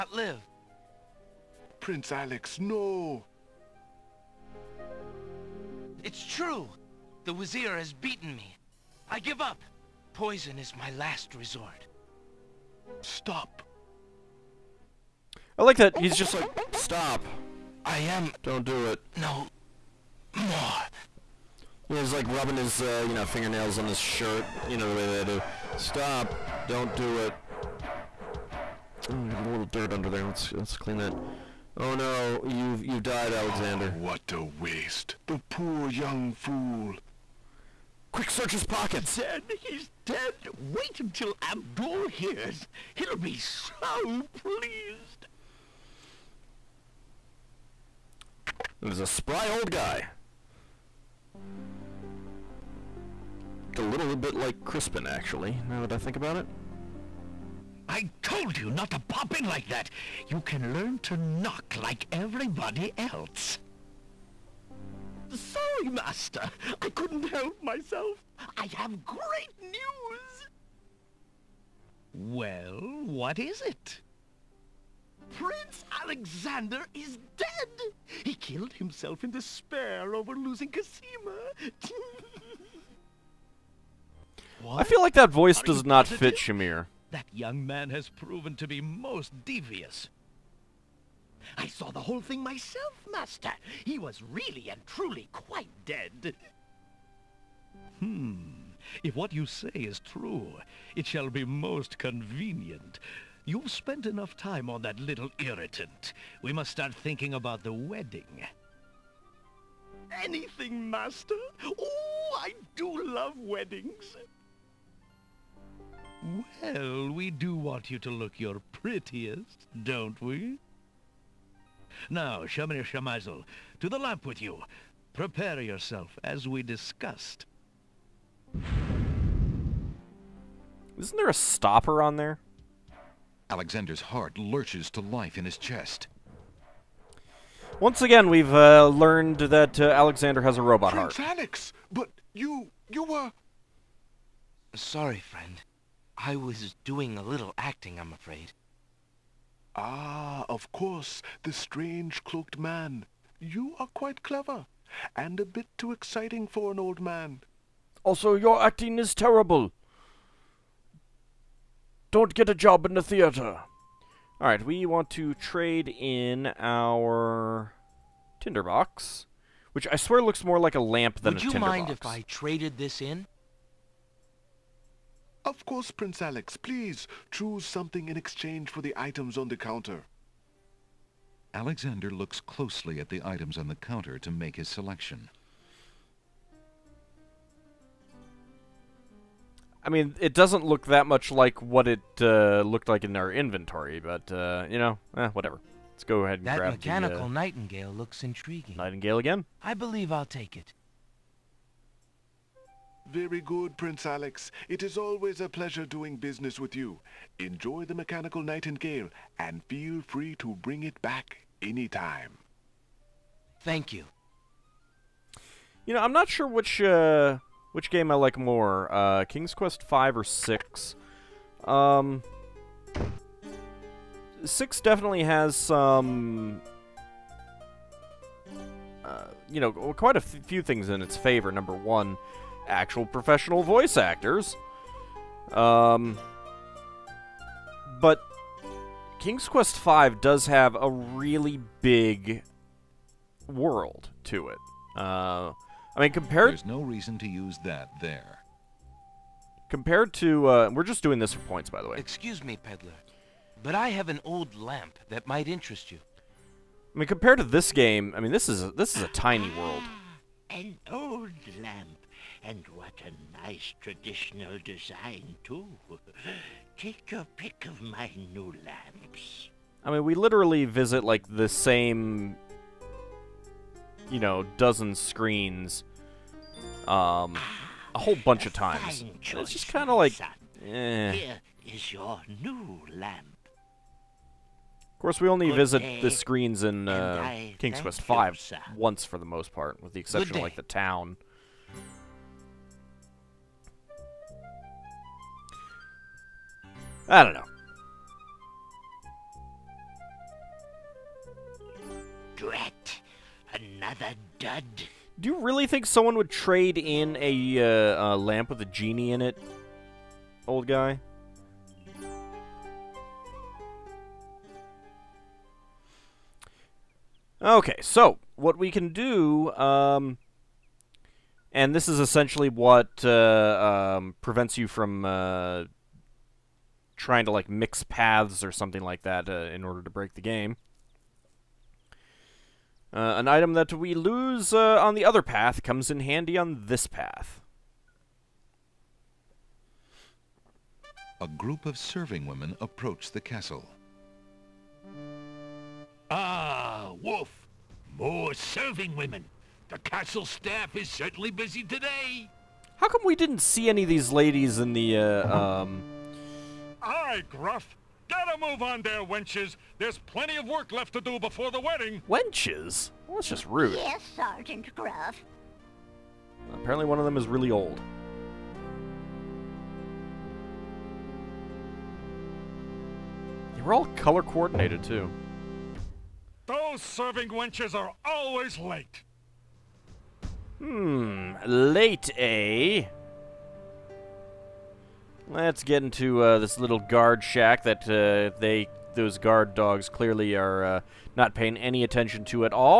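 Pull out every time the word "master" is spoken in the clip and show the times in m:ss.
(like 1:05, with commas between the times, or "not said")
1:05, 1:33, 1:50.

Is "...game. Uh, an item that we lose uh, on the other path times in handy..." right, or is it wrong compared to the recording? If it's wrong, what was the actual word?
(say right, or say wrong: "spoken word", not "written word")
wrong: "comes", not "times".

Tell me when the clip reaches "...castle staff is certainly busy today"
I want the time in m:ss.
5:49.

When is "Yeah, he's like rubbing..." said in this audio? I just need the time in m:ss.
0:21.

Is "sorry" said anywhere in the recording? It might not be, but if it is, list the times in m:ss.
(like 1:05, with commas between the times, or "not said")
1:05, 2:24.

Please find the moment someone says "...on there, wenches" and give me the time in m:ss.
5:58.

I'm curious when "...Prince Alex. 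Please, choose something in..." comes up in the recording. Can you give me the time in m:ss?
2:55.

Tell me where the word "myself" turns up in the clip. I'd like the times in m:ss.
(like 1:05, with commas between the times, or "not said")
1:07, 1:32.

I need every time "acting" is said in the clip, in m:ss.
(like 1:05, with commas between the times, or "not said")
2:27, 2:38.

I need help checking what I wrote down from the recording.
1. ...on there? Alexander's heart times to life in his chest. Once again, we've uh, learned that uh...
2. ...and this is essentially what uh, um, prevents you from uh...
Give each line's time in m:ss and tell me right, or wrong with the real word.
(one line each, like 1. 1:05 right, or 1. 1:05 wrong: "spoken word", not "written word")
1. 2:12 wrong: "lurches", not "times"
2. 5:21 right.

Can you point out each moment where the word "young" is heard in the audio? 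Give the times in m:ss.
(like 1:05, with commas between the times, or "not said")
0:35, 1:27.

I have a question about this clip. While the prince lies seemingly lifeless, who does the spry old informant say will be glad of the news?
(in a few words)
Abdul.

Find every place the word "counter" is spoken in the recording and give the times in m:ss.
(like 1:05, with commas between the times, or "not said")
2:59, 3:03.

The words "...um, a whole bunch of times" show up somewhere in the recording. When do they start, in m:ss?
4:36.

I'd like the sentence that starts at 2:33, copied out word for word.
You are quite clever, and a bit too exciting for an old man.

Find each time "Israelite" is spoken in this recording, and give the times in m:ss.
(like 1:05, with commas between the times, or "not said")
not said.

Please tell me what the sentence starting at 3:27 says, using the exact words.
Enjoy the mechanical nightingale, and feel free to bring it back anytime.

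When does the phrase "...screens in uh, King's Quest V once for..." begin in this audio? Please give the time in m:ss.
4:46.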